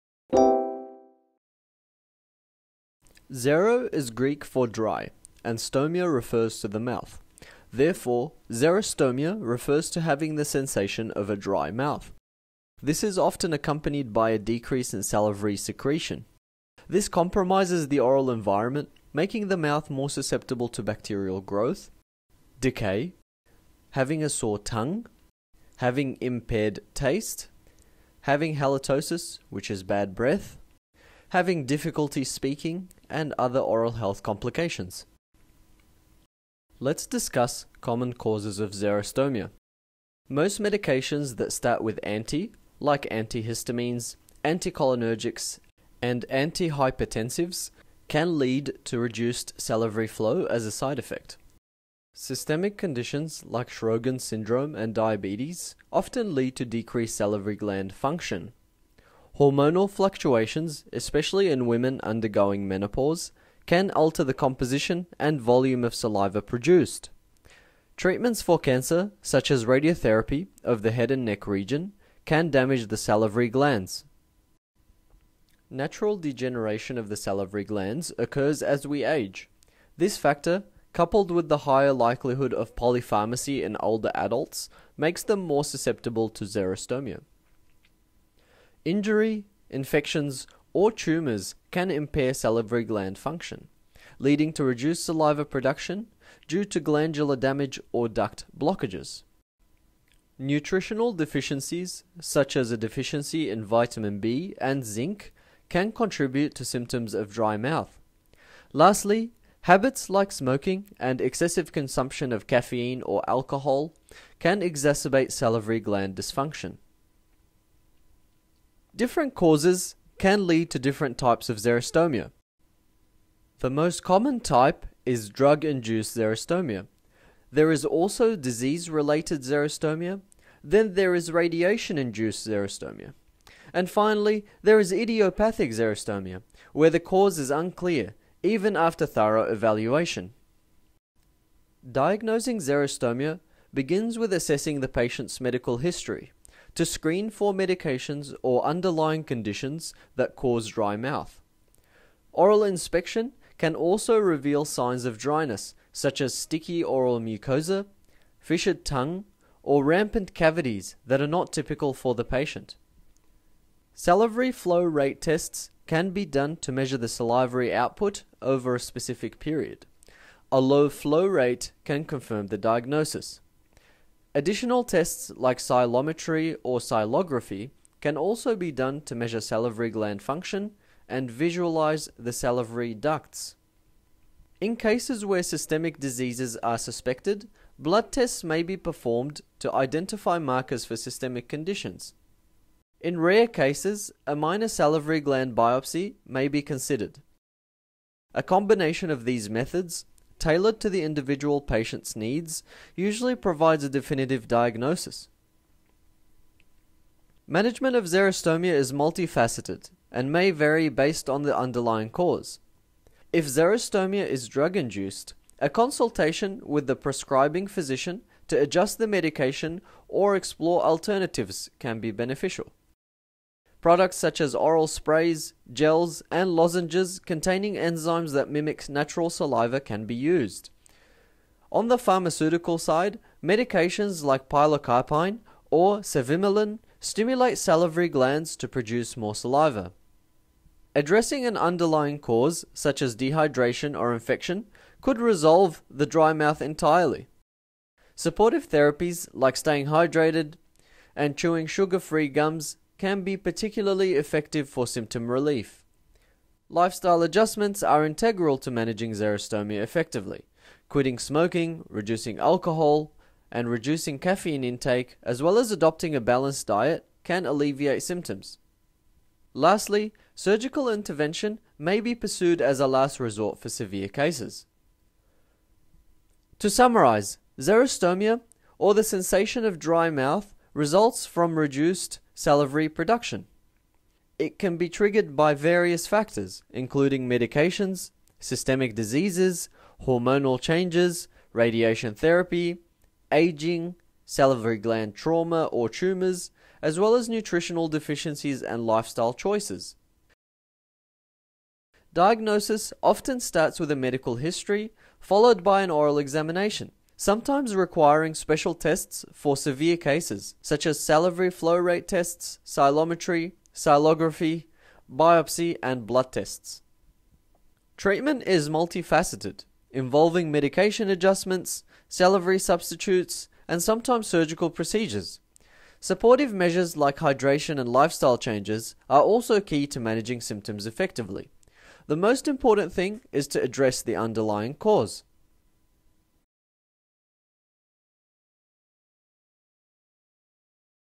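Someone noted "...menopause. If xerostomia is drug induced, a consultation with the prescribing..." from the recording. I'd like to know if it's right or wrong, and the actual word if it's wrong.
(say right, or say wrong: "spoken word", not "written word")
wrong: "cause", not "menopause".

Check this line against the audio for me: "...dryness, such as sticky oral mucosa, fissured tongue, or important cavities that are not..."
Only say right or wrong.
wrong.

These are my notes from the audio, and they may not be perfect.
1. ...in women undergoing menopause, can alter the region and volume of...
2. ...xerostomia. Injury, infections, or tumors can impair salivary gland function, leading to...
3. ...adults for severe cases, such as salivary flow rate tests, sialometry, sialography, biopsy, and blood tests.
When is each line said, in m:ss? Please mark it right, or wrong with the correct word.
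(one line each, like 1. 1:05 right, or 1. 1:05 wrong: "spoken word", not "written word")
1. 1:01 wrong: "composition", not "region"
2. 1:26 right
3. 5:08 wrong: "tests", not "adults".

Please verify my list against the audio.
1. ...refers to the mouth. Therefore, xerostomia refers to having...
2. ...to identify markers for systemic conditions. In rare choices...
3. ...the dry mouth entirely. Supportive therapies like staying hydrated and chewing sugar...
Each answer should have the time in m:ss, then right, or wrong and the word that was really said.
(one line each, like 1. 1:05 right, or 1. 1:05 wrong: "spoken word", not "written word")
1. 0:06 right
2. 3:09 wrong: "cases", not "choices"
3. 4:05 right.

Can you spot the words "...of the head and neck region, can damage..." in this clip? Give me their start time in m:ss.
1:10.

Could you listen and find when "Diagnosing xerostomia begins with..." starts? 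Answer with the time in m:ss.
2:21.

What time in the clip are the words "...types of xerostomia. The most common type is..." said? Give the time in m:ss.
2:01.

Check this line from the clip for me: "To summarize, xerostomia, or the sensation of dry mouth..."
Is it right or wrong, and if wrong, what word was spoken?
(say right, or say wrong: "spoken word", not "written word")
right.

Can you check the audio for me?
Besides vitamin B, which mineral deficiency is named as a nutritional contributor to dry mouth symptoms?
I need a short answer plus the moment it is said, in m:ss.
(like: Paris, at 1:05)
Zinc, at 1:44.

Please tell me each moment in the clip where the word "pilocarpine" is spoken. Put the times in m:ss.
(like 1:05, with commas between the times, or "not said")
3:54.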